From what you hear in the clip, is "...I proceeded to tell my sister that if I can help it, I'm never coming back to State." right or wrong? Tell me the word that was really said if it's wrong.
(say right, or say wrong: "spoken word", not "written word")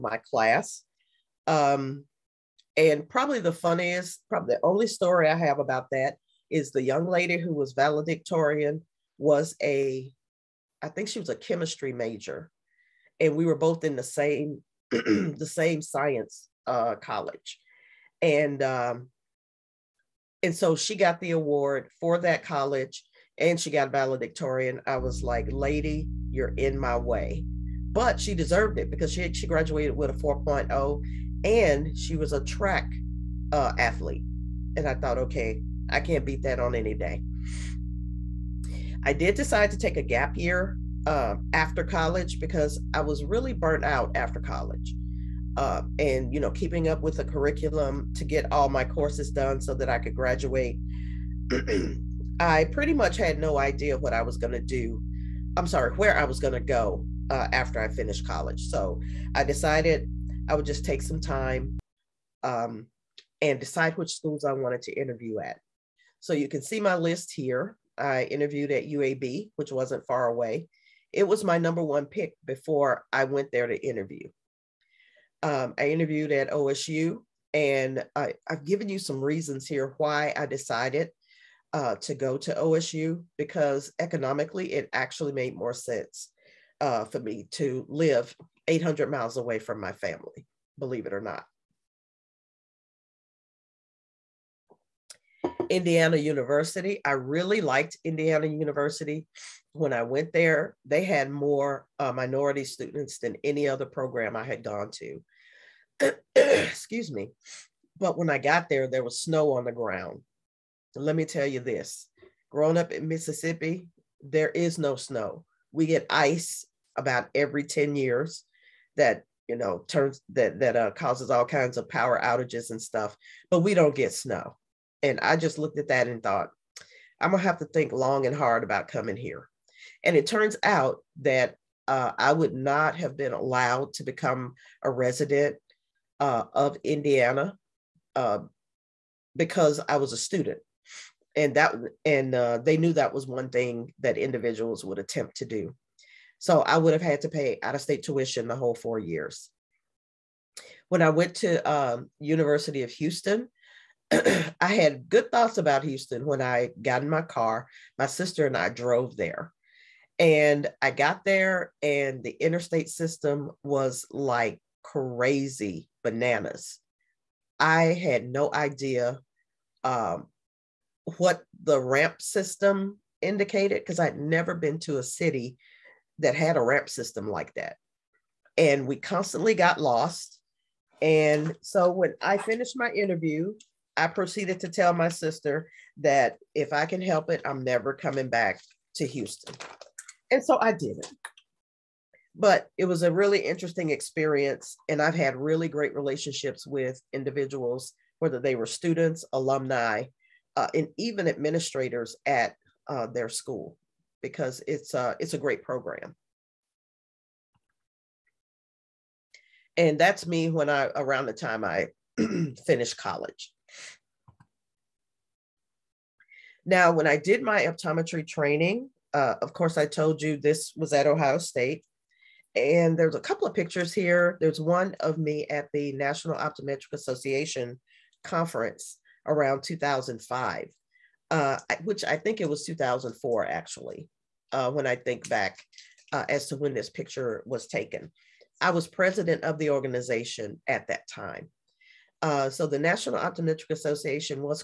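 wrong: "Houston", not "State".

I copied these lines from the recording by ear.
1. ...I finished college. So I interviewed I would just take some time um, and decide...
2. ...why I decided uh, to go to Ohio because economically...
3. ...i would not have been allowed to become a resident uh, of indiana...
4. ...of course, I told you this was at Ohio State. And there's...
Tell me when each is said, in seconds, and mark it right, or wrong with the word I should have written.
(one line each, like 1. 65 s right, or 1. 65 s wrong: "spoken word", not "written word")
1. 57 s wrong: "decided", not "interviewed"
2. 79 s wrong: "OSU", not "Ohio"
3. 132 s right
4. 219 s right.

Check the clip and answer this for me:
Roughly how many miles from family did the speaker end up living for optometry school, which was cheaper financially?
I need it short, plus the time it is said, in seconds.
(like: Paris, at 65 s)
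800, at 88 s.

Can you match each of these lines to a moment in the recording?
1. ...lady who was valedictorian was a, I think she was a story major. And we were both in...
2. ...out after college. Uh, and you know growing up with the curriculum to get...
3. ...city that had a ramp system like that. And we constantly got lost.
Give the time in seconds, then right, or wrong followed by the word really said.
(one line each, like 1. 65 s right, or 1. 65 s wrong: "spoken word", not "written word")
1. 7 s wrong: "chemistry", not "story"
2. 43 s wrong: "keeping", not "growing"
3. 175 s right.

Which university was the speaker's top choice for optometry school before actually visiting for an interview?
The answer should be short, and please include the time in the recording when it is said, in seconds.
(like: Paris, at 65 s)
UAB, at 68 s.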